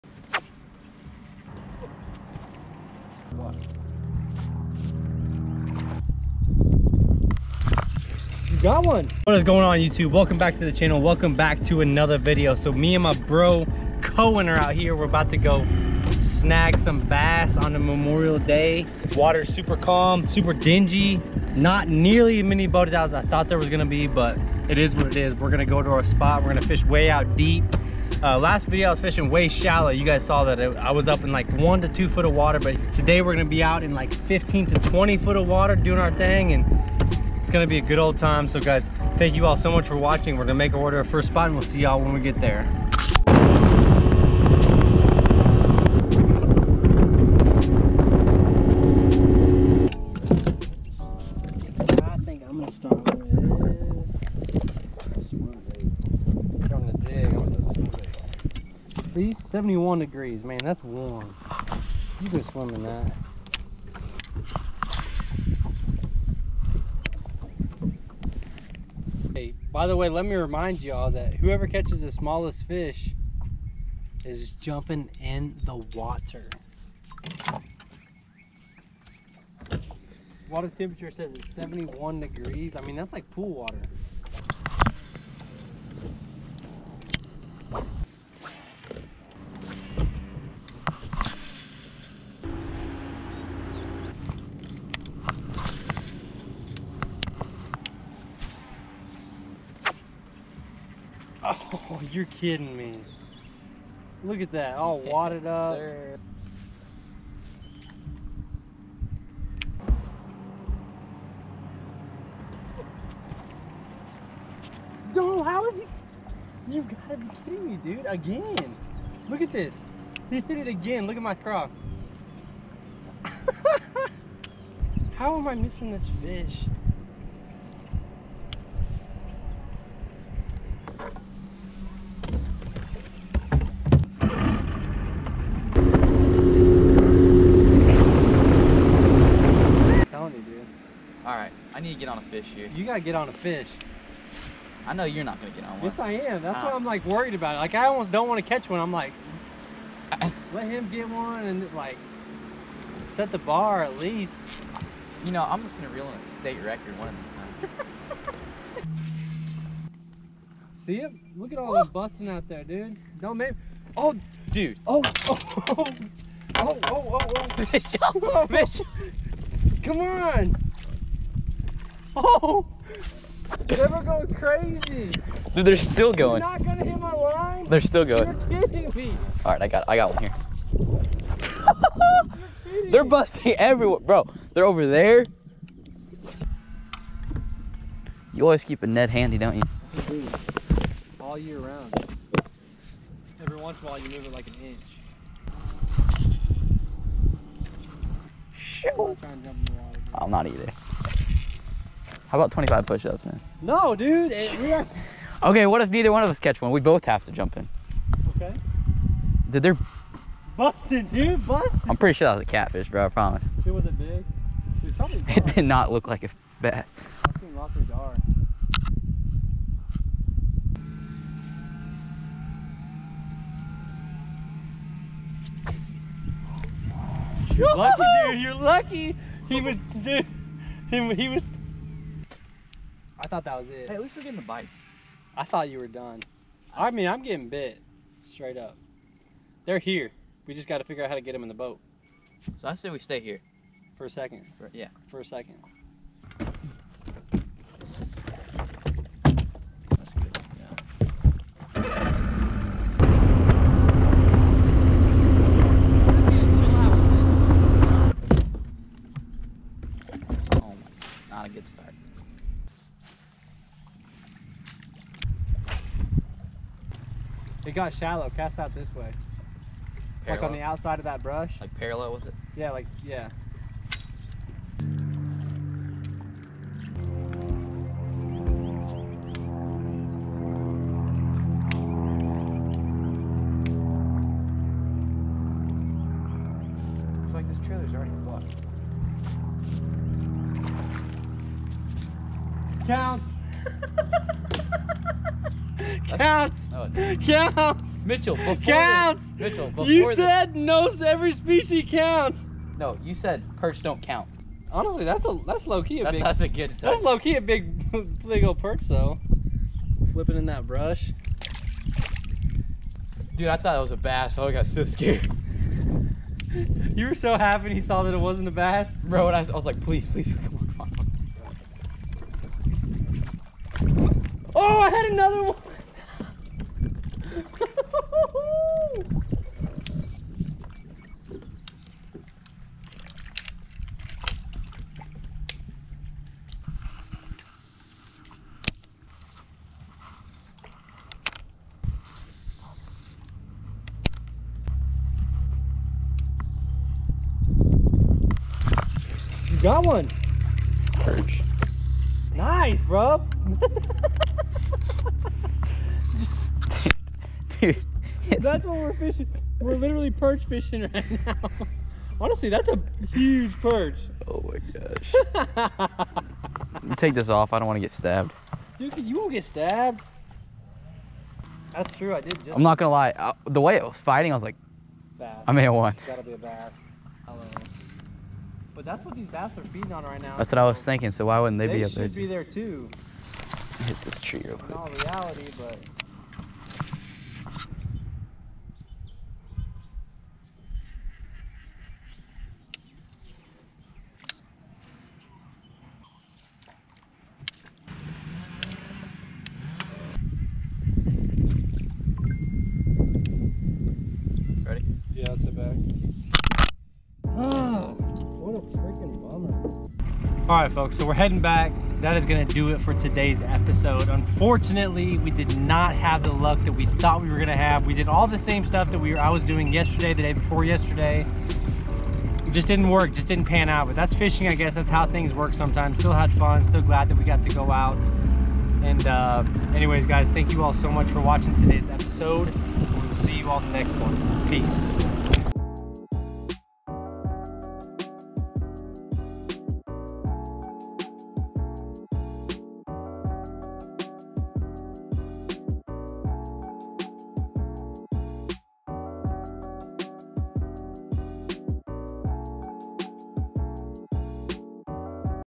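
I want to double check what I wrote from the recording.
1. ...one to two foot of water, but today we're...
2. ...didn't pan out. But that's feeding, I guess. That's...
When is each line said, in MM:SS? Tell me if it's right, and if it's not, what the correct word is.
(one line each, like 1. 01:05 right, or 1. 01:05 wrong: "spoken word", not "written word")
1. 00:31 right
2. 07:03 wrong: "fishing", not "feeding".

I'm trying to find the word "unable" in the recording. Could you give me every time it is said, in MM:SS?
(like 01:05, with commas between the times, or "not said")
not said.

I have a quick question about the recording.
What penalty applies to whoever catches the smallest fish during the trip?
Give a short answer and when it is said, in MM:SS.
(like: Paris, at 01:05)
Jumping in the water, at 01:14.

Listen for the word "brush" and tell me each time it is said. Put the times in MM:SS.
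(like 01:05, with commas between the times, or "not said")
04:31, 05:10.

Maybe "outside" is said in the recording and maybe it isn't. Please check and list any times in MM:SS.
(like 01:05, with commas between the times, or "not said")
04:30.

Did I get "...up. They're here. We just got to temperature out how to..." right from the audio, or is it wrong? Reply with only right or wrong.
wrong.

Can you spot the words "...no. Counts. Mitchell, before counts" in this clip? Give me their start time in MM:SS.
04:56.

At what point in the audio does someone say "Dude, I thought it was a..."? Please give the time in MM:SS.
05:13.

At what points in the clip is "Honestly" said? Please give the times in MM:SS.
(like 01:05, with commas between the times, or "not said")
05:04, 06:02.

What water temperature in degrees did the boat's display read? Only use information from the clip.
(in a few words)
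71.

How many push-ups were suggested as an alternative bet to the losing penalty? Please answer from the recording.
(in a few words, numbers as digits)
25.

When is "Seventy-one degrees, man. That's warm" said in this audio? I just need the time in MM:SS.
00:59.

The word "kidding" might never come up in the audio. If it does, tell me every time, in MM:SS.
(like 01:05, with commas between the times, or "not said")
01:42, 01:57, 02:58.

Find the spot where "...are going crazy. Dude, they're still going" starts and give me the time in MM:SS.
02:53.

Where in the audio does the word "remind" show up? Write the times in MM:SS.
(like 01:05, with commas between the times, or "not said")
01:10.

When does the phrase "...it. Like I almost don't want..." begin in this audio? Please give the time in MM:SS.
02:27.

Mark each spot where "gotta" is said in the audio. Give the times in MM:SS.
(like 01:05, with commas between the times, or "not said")
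02:22, 06:16.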